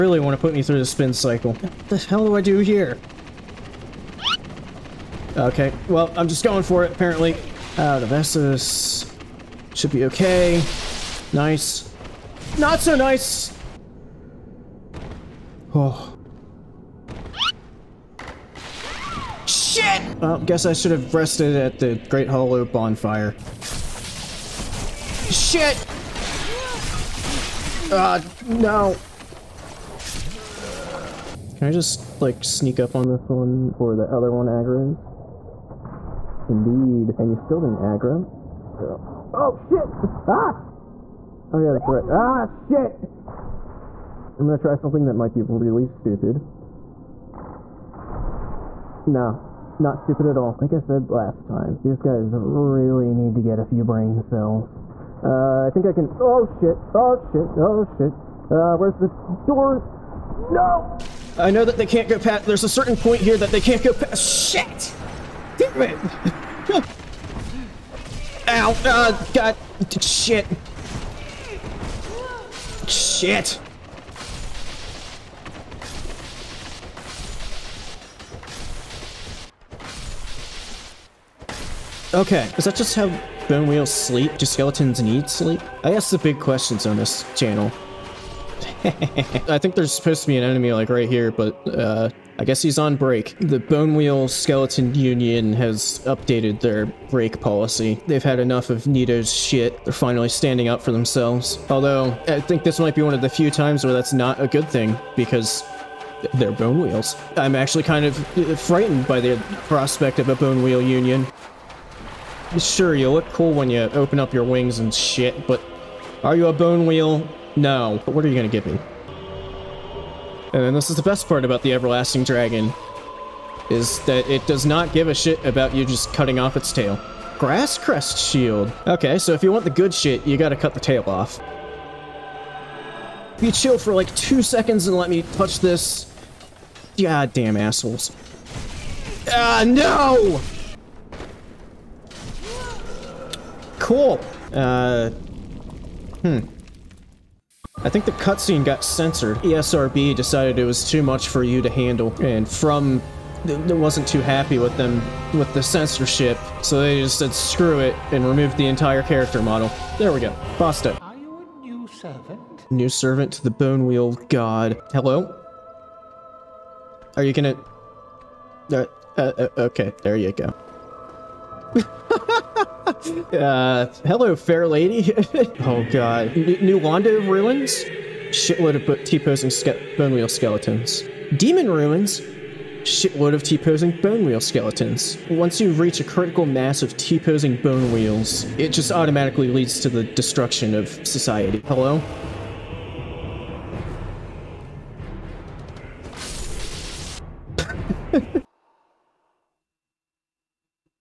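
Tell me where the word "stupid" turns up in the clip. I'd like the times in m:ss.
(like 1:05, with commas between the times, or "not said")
0:45, 0:49.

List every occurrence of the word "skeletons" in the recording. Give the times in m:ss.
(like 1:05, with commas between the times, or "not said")
1:24, 1:34, 3:00, 3:04.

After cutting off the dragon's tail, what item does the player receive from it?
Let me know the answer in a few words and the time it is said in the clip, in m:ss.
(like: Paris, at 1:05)
Grass crest shield, at 2:07.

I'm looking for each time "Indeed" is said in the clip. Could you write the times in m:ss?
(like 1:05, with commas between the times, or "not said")
0:36.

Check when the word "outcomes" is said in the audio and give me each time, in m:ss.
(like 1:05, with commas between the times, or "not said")
not said.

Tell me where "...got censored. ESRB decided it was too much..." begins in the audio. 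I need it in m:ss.
2:28.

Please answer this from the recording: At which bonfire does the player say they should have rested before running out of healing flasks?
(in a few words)
Great Hollow.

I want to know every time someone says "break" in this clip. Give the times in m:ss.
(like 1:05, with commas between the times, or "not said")
1:32, 1:37.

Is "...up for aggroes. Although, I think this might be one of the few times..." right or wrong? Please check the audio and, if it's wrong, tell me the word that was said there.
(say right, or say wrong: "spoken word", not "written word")
wrong: "themselves", not "aggroes".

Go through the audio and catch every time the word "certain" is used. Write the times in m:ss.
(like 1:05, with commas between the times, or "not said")
1:02.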